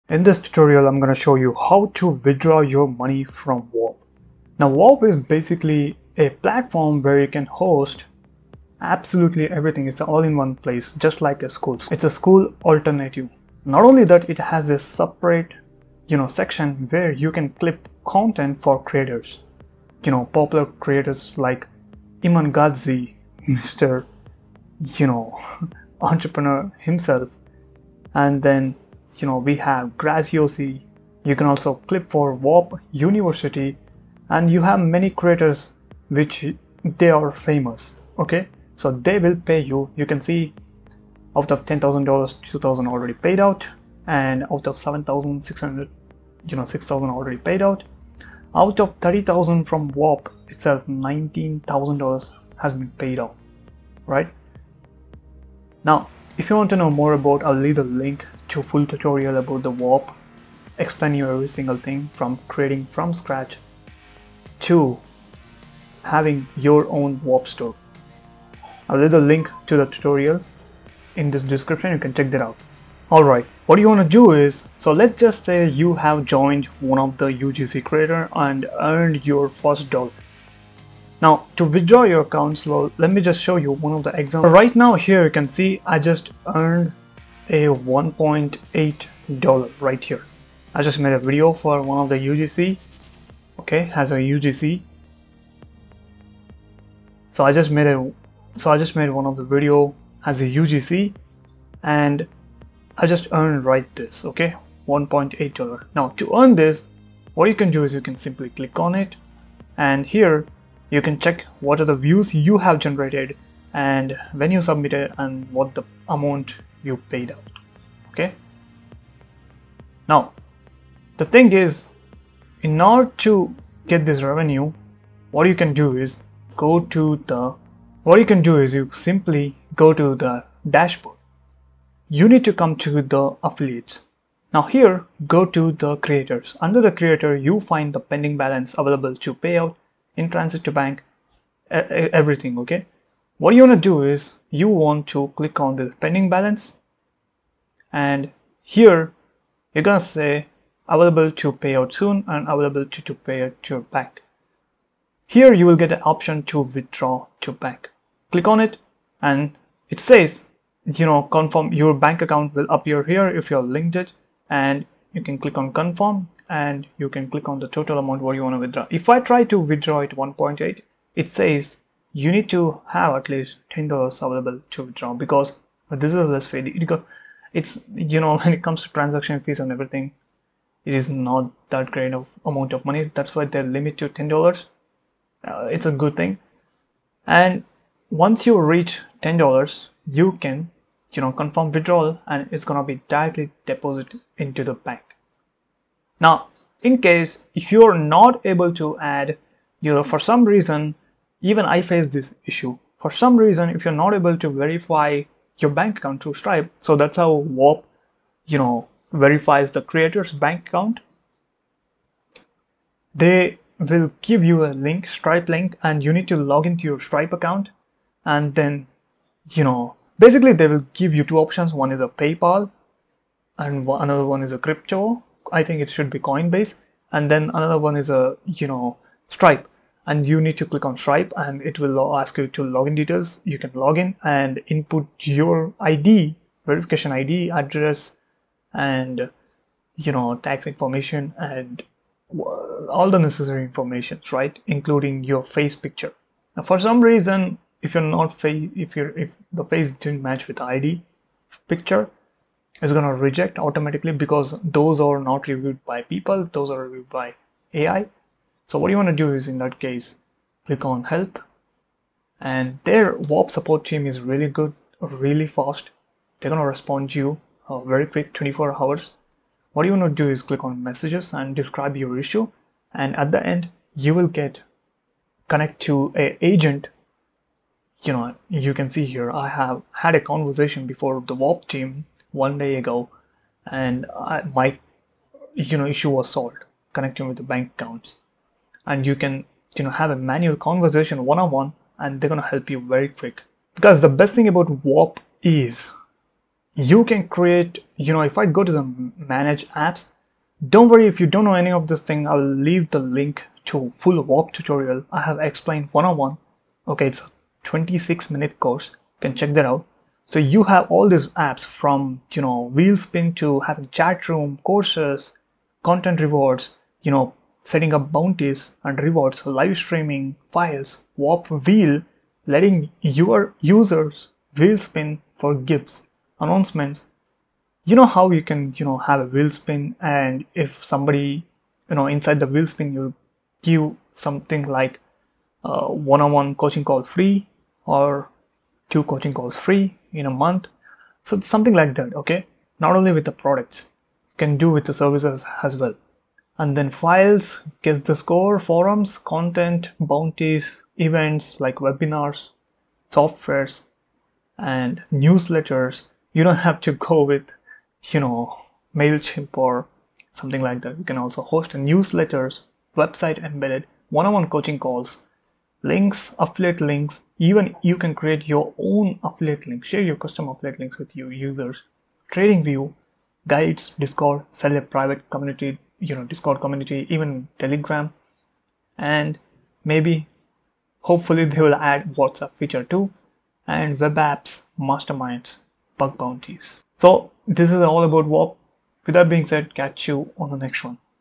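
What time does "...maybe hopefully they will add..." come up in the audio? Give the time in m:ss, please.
6:19.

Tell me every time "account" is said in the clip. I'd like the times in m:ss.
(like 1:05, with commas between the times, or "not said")
2:42, 3:25, 3:30, 3:37, 4:47.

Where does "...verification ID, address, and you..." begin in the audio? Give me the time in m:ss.
3:56.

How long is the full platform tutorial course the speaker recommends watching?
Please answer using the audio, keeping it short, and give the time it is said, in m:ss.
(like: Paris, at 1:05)
26 minutes, at 5:07.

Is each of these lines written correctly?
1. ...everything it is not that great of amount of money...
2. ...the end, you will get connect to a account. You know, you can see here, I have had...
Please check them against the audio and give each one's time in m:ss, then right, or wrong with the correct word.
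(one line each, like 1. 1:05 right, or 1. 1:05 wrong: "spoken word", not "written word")
1. 2:59 right
2. 4:33 wrong: "agent", not "account".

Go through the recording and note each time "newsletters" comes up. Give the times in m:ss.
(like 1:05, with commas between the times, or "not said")
5:55, 6:01.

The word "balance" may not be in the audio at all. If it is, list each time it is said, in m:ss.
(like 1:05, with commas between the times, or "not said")
2:18, 2:26.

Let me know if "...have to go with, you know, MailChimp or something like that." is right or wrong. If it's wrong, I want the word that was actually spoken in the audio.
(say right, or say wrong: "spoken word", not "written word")
right.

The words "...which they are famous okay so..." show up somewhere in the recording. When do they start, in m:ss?
0:36.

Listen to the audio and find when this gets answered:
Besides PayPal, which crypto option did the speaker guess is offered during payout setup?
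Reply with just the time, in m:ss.
3:46.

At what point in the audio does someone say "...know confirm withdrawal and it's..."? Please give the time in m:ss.
3:11.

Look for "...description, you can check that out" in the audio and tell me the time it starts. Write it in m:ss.
1:11.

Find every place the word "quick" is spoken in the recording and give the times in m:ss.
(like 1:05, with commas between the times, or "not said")
4:28, 4:53.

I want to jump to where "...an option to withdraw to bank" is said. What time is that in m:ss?
2:35.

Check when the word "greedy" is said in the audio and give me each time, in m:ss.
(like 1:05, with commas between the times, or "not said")
not said.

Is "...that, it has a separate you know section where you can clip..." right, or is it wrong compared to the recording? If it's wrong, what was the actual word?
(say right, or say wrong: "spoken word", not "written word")
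right.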